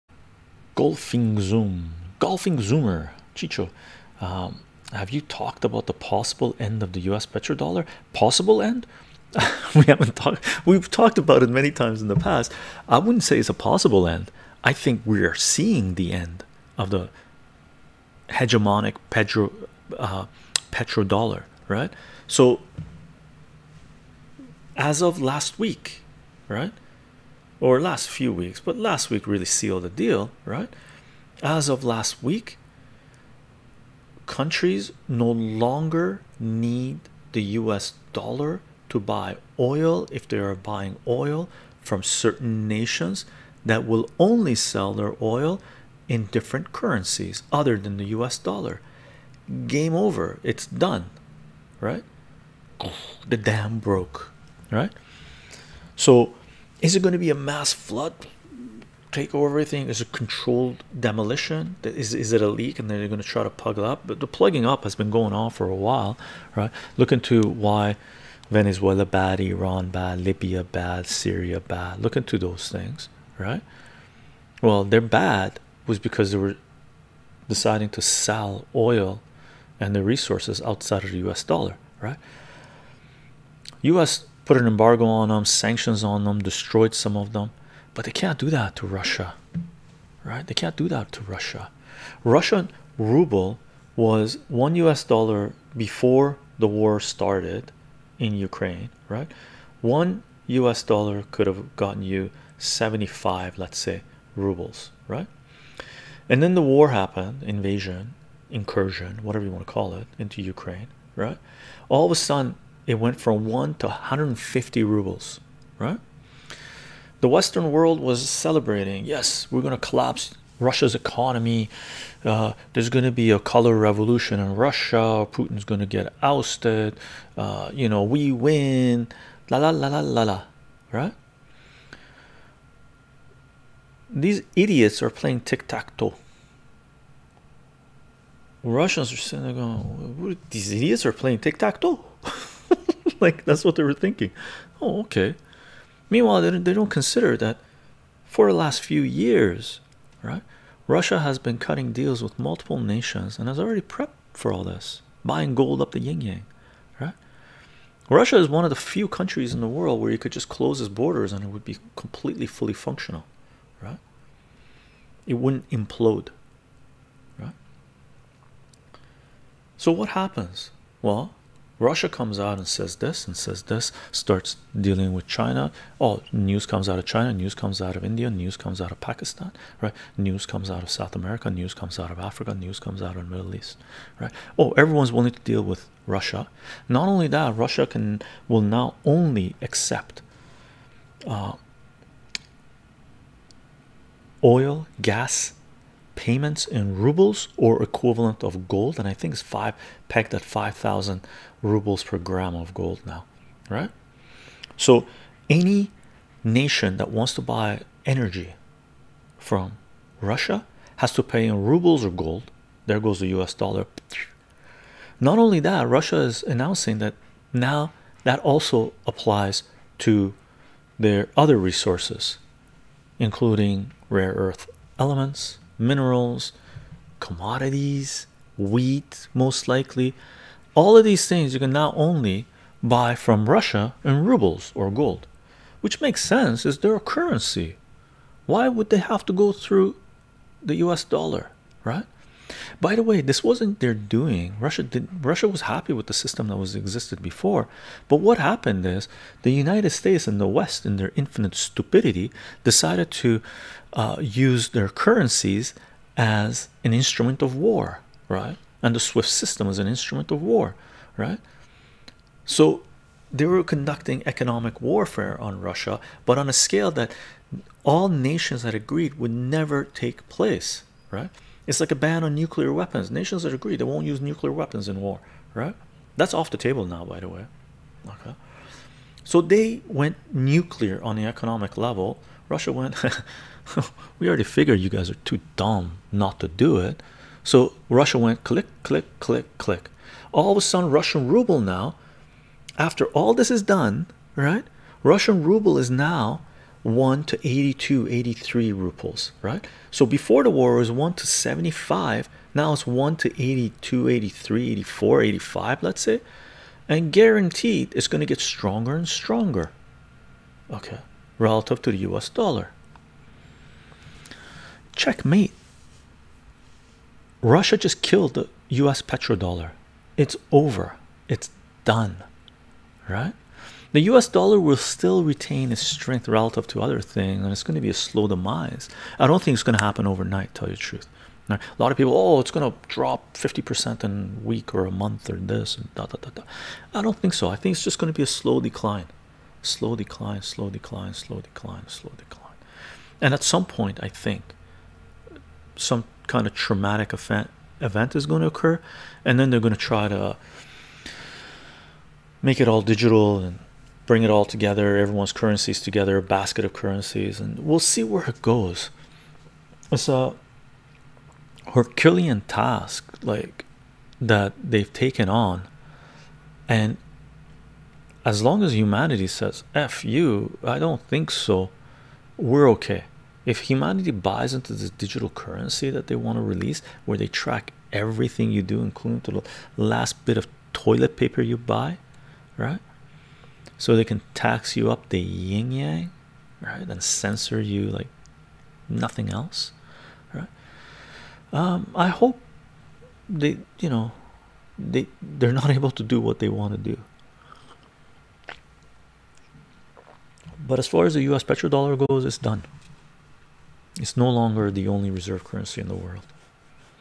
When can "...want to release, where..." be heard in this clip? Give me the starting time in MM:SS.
06:16.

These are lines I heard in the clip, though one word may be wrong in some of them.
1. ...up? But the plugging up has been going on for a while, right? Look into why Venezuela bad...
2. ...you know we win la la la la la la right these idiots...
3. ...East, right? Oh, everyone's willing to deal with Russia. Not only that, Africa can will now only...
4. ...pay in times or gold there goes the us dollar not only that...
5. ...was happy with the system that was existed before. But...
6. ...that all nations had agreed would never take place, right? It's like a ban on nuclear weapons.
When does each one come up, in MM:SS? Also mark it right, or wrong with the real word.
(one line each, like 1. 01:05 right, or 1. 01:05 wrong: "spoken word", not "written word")
1. 01:03 right
2. 02:07 right
3. 03:03 wrong: "Russia", not "Africa"
4. 03:31 wrong: "rubles", not "times"
5. 04:05 right
6. 04:26 right.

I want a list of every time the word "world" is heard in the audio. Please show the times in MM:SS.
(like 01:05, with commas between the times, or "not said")
01:57, 02:39, 06:45.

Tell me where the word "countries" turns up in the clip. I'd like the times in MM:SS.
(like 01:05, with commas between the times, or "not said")
00:34, 02:39.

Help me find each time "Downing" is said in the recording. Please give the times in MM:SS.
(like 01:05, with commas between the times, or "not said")
not said.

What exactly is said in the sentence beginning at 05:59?
It's a Herculean task, like that they've taken on, and as long as humanity says "f you," I don't think so.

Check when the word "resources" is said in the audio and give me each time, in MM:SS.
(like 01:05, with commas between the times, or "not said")
01:20, 03:41.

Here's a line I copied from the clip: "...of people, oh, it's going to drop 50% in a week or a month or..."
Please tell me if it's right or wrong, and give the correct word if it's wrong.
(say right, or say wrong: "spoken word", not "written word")
right.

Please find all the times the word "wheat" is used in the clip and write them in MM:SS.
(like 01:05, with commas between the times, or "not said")
03:48.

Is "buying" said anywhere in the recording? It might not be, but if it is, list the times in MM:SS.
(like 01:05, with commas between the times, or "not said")
00:40, 02:35.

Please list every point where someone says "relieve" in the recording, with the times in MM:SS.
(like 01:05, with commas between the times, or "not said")
not said.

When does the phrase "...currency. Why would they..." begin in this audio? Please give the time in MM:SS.
03:56.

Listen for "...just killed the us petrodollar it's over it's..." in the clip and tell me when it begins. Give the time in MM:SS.
05:17.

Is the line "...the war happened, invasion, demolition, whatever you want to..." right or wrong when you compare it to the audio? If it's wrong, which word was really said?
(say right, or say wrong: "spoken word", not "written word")
wrong: "incursion", not "demolition".